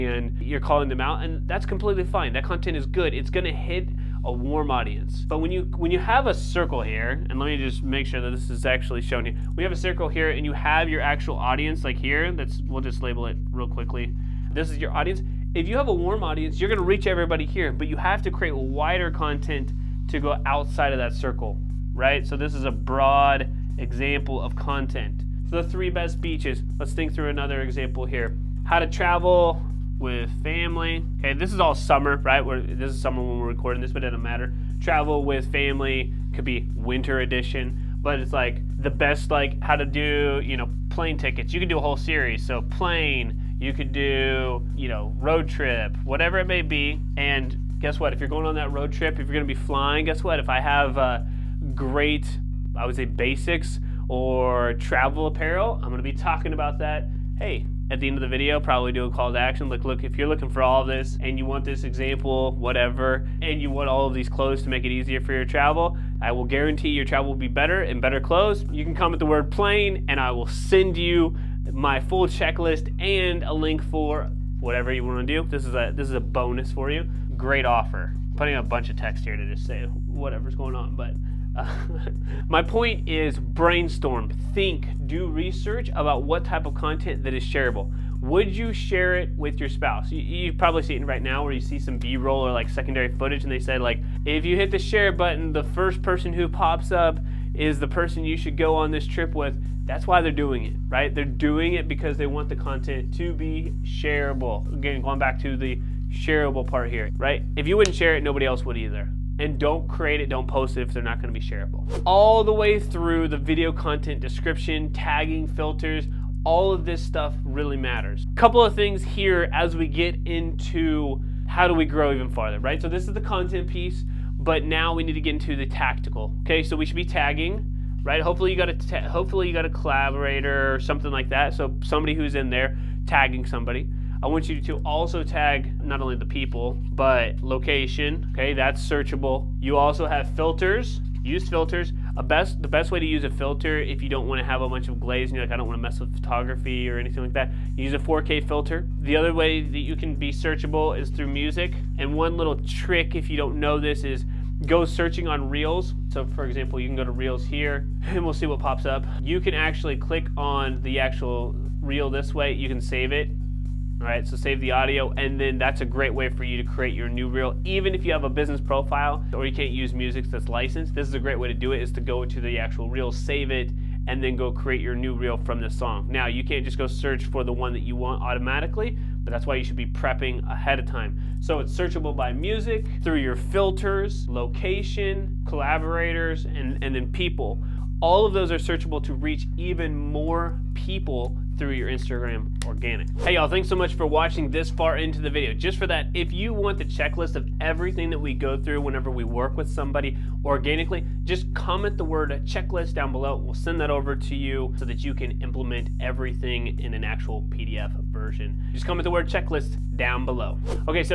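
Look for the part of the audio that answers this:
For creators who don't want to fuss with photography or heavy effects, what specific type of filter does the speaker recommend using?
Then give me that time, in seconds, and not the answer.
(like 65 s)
147 s.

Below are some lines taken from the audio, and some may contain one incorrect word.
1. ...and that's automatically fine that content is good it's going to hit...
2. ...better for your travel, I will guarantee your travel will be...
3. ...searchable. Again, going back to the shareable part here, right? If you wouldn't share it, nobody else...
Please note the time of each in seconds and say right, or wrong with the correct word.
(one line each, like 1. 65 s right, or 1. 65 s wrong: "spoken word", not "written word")
1. 1 s wrong: "completely", not "automatically"
2. 64 s wrong: "easier", not "better"
3. 103 s wrong: "shareable", not "searchable".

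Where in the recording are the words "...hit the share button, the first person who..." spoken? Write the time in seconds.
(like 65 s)
94 s.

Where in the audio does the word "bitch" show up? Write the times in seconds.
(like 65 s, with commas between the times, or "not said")
not said.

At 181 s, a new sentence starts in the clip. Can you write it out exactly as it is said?
So it's searchable by music, through your filters, location, collaborators, and, and then people.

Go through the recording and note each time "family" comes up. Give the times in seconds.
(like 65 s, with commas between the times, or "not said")
30 s, 35 s.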